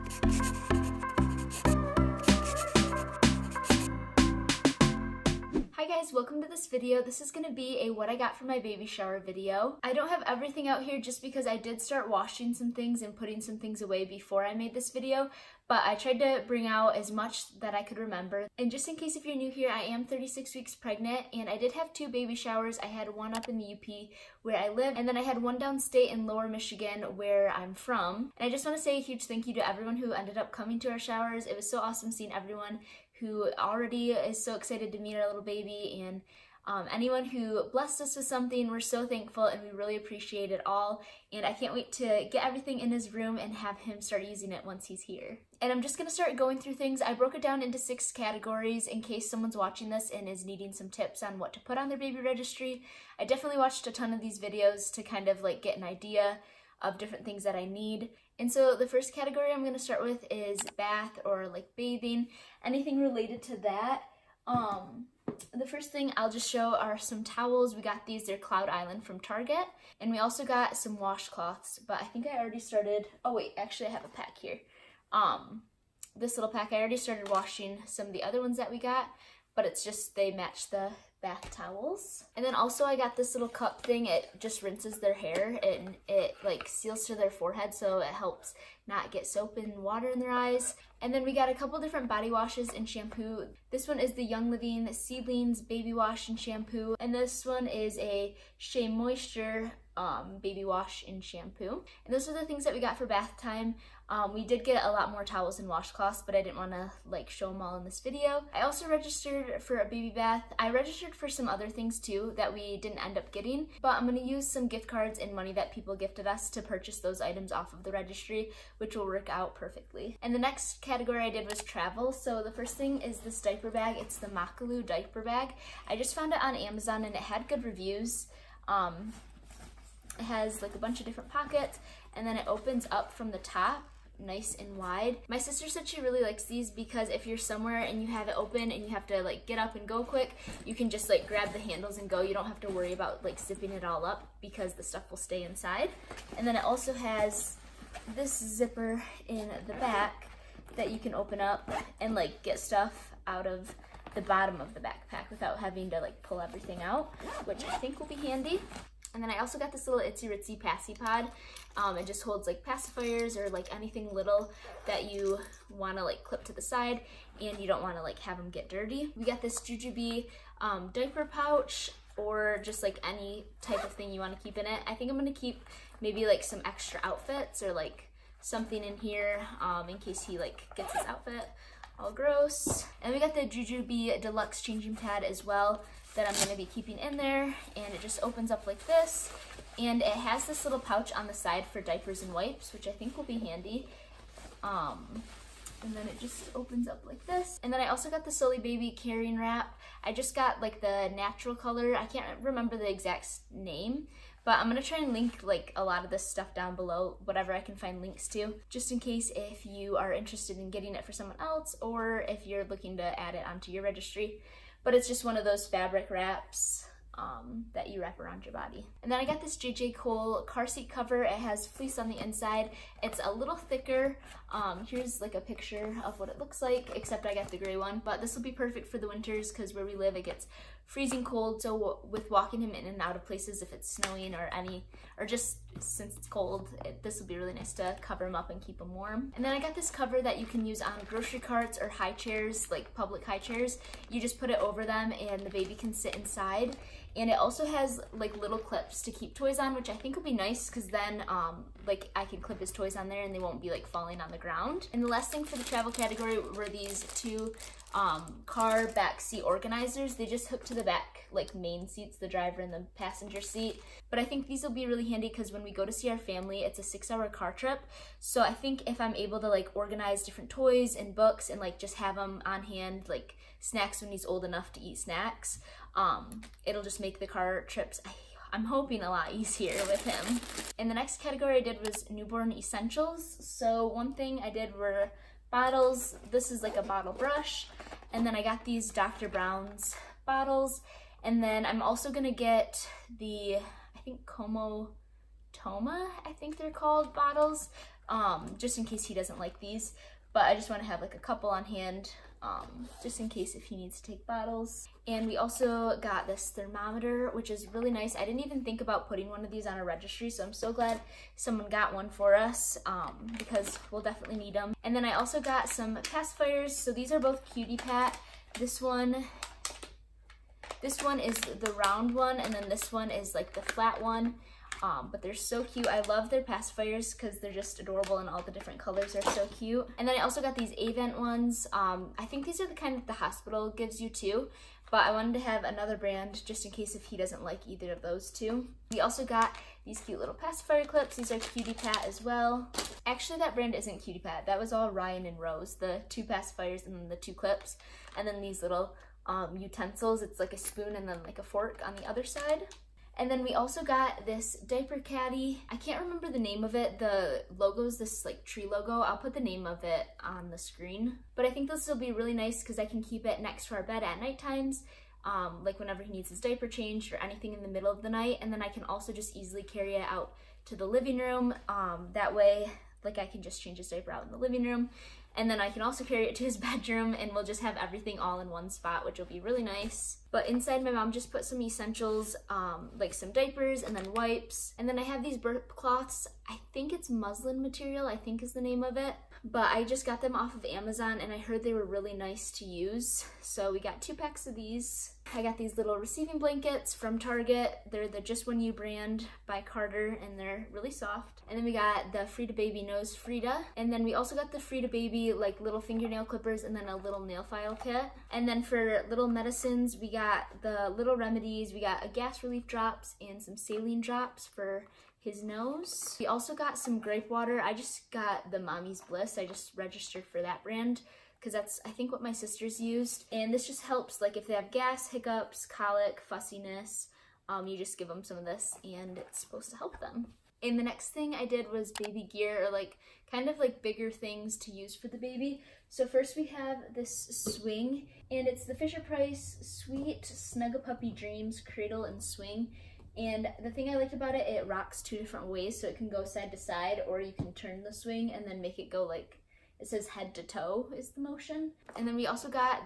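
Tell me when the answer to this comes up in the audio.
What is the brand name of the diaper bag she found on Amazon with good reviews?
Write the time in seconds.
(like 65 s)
124 s.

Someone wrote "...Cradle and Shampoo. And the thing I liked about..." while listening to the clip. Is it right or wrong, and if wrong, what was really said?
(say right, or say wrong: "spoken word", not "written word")
wrong: "Swing", not "Shampoo".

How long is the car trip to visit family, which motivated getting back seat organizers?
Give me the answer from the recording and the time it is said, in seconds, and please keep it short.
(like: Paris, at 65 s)
6 hours, at 266 s.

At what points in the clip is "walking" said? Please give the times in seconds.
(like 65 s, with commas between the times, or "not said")
232 s.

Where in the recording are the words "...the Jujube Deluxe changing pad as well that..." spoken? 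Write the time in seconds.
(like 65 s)
183 s.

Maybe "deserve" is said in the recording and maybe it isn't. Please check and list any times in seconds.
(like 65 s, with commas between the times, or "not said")
not said.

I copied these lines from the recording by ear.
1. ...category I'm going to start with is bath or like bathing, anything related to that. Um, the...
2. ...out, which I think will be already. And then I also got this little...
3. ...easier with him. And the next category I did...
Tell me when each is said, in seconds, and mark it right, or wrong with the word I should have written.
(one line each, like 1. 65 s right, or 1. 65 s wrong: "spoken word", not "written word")
1. 59 s right
2. 156 s wrong: "handy", not "already"
3. 279 s right.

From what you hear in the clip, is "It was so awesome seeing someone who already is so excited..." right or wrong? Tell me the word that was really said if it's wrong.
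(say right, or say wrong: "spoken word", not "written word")
wrong: "everyone", not "someone".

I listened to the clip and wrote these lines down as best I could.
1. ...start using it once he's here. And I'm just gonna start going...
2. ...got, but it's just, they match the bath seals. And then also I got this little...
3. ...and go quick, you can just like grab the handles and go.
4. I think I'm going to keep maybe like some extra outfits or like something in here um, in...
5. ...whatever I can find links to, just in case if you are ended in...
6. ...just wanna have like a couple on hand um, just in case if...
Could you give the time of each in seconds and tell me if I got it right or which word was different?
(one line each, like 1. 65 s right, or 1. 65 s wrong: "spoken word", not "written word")
1. 44 s right
2. 78 s wrong: "towels", not "seals"
3. 139 s right
4. 174 s right
5. 207 s wrong: "interested", not "ended"
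6. 300 s right.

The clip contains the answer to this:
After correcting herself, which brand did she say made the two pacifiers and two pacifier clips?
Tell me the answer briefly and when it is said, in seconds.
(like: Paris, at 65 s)
Ryan and Rose, at 344 s.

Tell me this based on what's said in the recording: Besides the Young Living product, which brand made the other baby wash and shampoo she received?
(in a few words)
Shea Moisture.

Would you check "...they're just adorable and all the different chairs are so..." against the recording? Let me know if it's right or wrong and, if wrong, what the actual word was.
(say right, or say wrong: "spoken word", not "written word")
wrong: "colors", not "chairs".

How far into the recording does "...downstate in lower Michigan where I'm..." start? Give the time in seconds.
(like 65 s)
25 s.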